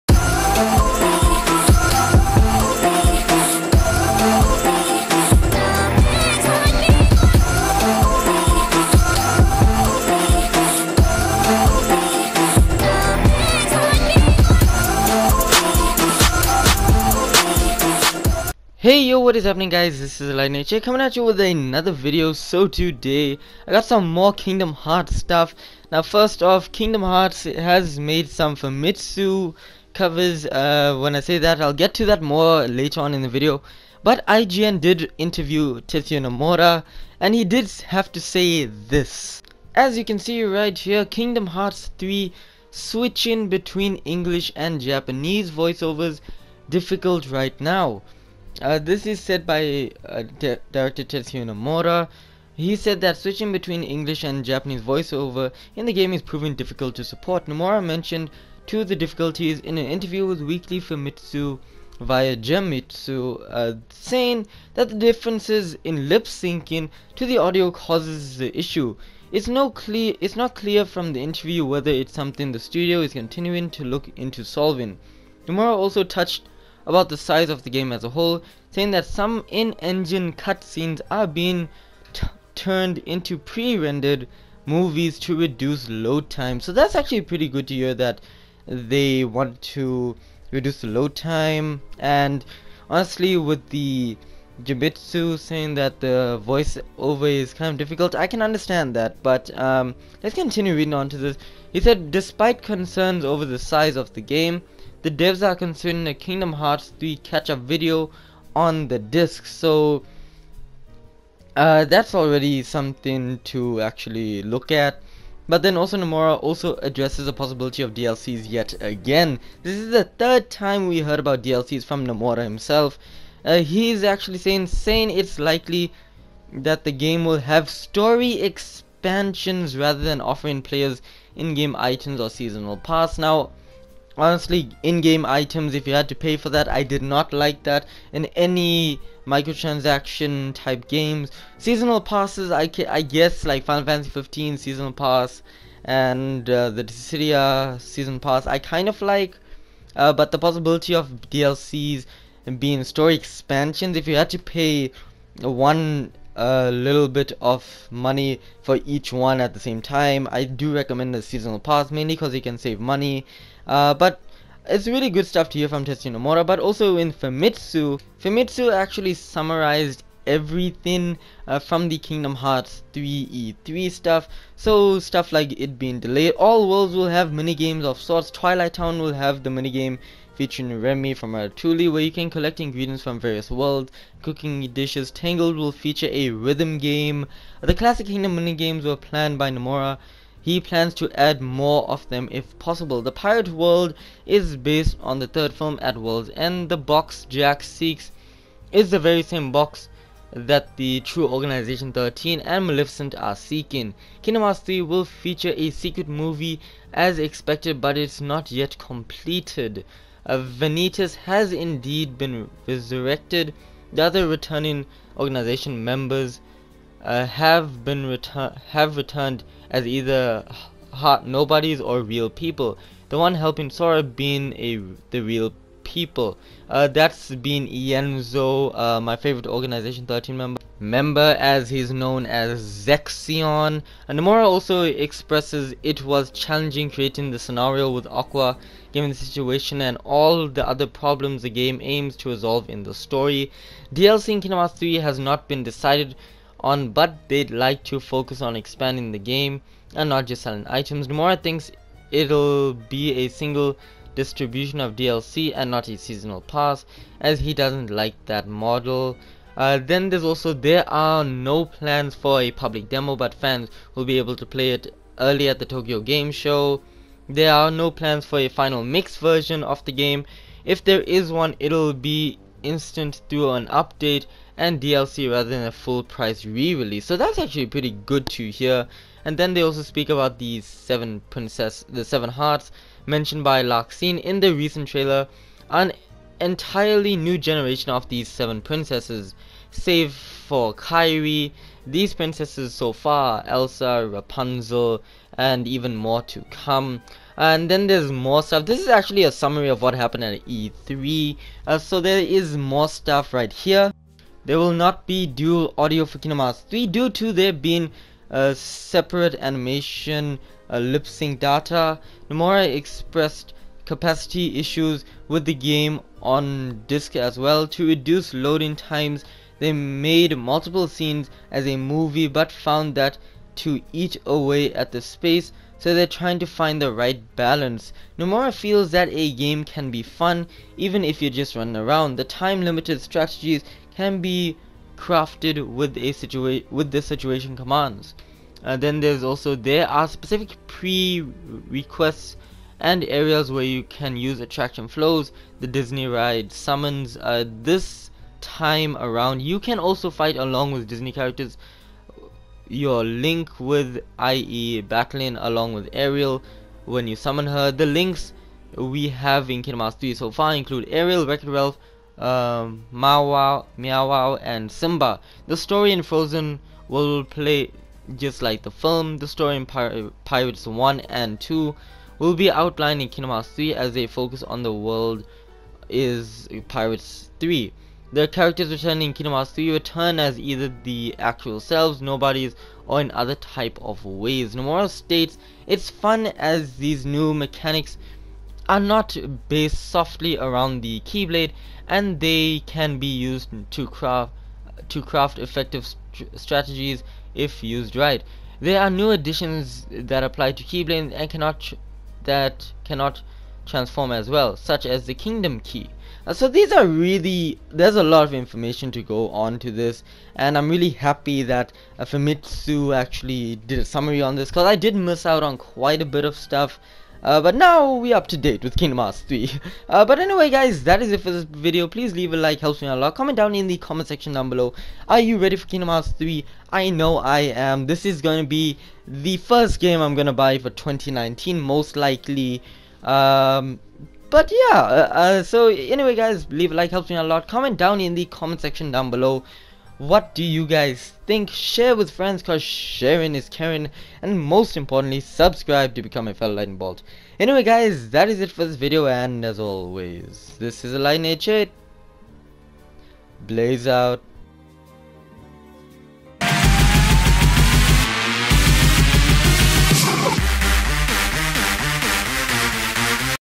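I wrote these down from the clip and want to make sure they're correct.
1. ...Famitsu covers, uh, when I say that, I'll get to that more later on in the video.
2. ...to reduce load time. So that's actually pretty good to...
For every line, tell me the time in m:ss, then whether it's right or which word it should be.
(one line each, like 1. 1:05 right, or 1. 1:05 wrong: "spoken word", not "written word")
1. 0:28 right
2. 1:25 right.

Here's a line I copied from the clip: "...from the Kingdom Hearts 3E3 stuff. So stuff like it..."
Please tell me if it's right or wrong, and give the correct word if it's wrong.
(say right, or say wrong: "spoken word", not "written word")
right.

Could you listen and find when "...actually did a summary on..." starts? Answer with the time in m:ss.
6:52.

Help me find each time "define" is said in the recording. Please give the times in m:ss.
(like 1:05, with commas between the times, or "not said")
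not said.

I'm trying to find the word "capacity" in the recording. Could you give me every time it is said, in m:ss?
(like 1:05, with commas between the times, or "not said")
5:13.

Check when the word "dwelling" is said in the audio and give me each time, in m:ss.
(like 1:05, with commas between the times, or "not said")
not said.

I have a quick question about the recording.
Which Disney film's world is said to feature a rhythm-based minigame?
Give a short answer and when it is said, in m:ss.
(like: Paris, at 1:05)
Tangled, at 3:05.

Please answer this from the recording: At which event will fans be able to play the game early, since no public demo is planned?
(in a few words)
Tokyo Game Show.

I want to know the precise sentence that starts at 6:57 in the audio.
Uh, but now we're up to date with Kingdom Hearts 3.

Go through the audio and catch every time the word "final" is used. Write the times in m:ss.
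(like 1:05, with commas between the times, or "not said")
2:23, 4:28.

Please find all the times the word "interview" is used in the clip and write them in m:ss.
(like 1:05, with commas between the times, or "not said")
0:35, 0:59, 1:11.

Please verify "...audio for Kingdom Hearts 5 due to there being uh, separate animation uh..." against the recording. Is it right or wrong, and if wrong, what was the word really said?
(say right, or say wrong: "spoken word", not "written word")
wrong: "3", not "5".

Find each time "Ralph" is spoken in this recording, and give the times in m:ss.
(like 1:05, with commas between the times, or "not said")
6:01.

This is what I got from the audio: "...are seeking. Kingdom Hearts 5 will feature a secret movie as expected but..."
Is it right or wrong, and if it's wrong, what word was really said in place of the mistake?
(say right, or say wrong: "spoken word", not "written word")
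wrong: "3", not "5".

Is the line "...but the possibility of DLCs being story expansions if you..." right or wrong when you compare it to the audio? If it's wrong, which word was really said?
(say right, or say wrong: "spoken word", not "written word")
right.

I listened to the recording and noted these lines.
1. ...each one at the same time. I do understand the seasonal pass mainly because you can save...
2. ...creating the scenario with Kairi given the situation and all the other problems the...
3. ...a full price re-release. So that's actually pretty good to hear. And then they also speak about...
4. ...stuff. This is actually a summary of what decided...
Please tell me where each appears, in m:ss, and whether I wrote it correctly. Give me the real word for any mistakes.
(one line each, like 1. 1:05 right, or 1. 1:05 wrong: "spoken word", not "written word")
1. 2:38 wrong: "recommend", not "understand"
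2. 3:56 wrong: "Aqua", not "Kairi"
3. 4:35 right
4. 4:58 wrong: "happened", not "decided".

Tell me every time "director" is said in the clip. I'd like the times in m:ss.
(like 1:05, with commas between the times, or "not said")
0:50.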